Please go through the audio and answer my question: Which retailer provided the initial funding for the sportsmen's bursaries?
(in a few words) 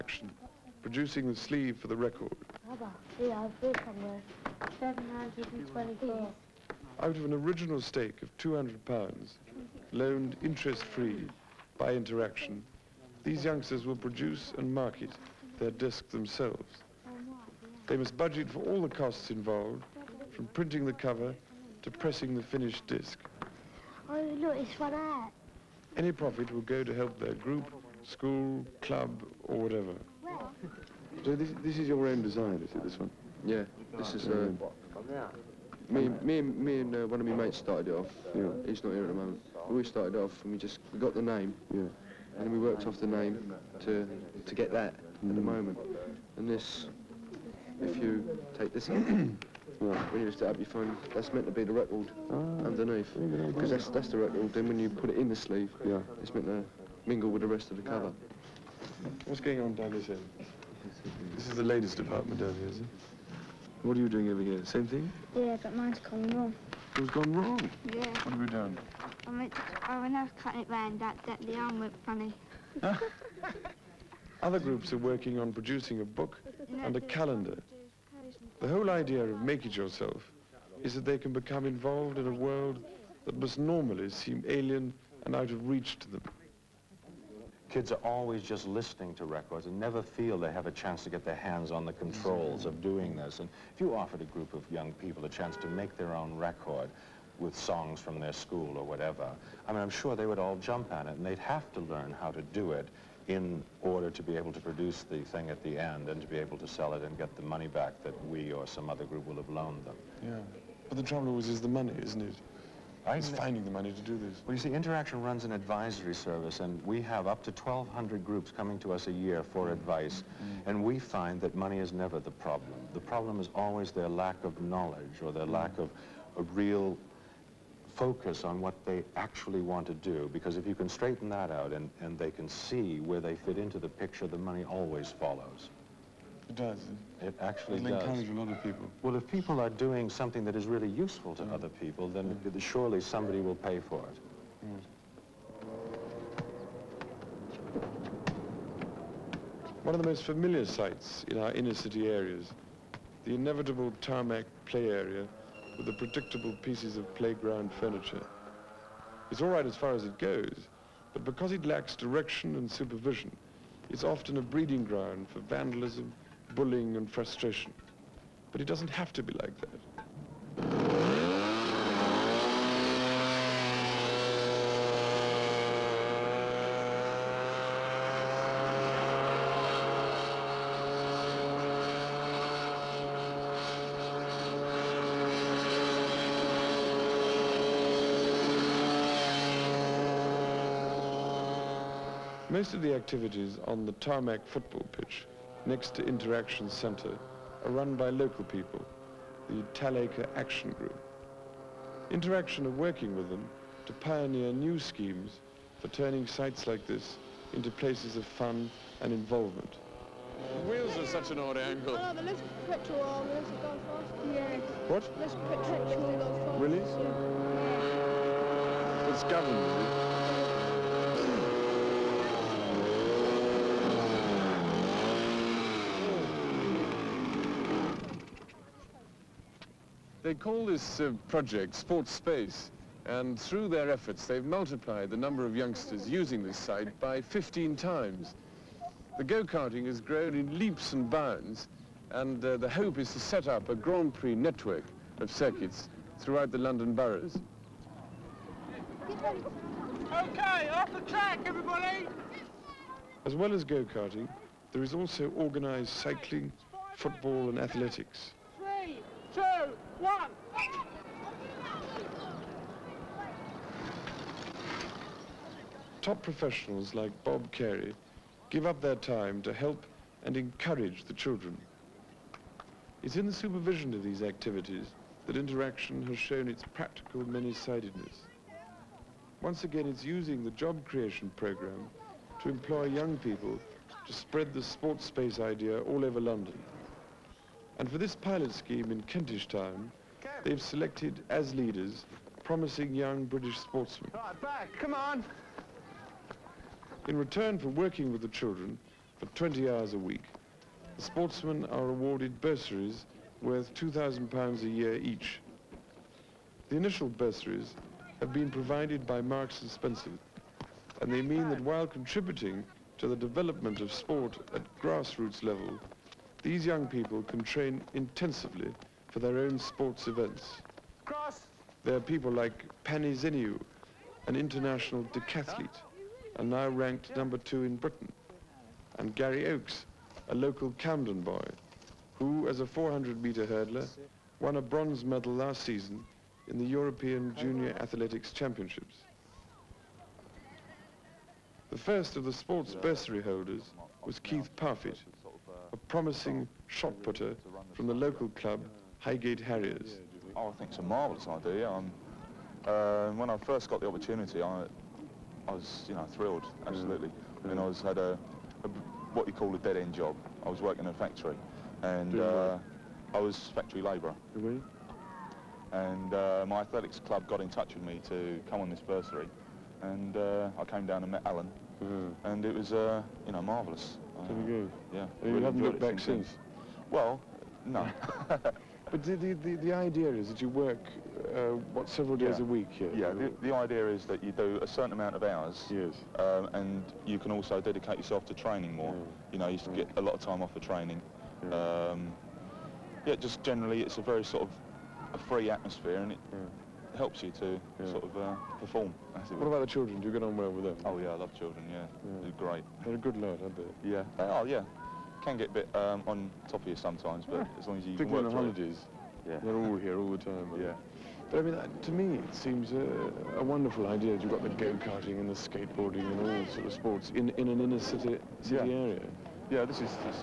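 Marks and Spencer.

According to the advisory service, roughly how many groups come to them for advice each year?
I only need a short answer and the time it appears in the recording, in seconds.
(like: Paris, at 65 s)
1,200, at 117 s.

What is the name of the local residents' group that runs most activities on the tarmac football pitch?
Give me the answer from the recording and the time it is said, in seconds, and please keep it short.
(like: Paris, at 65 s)
Talacre Action Group, at 199 s.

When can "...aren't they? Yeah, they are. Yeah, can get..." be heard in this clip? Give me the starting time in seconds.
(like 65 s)
403 s.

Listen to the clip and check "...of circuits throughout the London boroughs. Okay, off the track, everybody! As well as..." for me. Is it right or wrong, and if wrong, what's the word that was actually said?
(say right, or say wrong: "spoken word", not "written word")
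right.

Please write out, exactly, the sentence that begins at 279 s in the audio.
Once again, it's using the job creation program to employ young people to spread the sports space idea all over London.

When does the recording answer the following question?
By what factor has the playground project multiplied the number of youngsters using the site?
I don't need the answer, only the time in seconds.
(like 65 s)
237 s.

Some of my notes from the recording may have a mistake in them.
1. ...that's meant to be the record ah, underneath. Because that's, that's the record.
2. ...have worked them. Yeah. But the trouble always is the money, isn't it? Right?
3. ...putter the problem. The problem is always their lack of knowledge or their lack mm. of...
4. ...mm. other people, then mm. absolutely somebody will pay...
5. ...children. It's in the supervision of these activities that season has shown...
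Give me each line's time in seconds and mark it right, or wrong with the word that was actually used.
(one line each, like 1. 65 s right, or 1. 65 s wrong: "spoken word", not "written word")
1. 51 s right
2. 109 s wrong: "loaned", not "worked"
3. 121 s wrong: "never", not "putter"
4. 141 s wrong: "surely", not "absolutely"
5. 271 s wrong: "interaction", not "season".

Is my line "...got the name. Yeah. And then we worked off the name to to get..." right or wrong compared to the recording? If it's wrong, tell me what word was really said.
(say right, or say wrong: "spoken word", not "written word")
right.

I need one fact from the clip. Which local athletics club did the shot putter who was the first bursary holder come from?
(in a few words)
Highgate Harriers.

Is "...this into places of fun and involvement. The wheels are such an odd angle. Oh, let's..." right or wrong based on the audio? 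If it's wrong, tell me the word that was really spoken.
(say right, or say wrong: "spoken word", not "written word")
right.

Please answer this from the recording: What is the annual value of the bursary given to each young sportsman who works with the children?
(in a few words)
£2,000.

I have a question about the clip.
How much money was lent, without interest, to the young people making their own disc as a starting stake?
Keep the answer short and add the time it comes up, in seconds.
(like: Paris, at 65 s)
200 pounds, at 8 s.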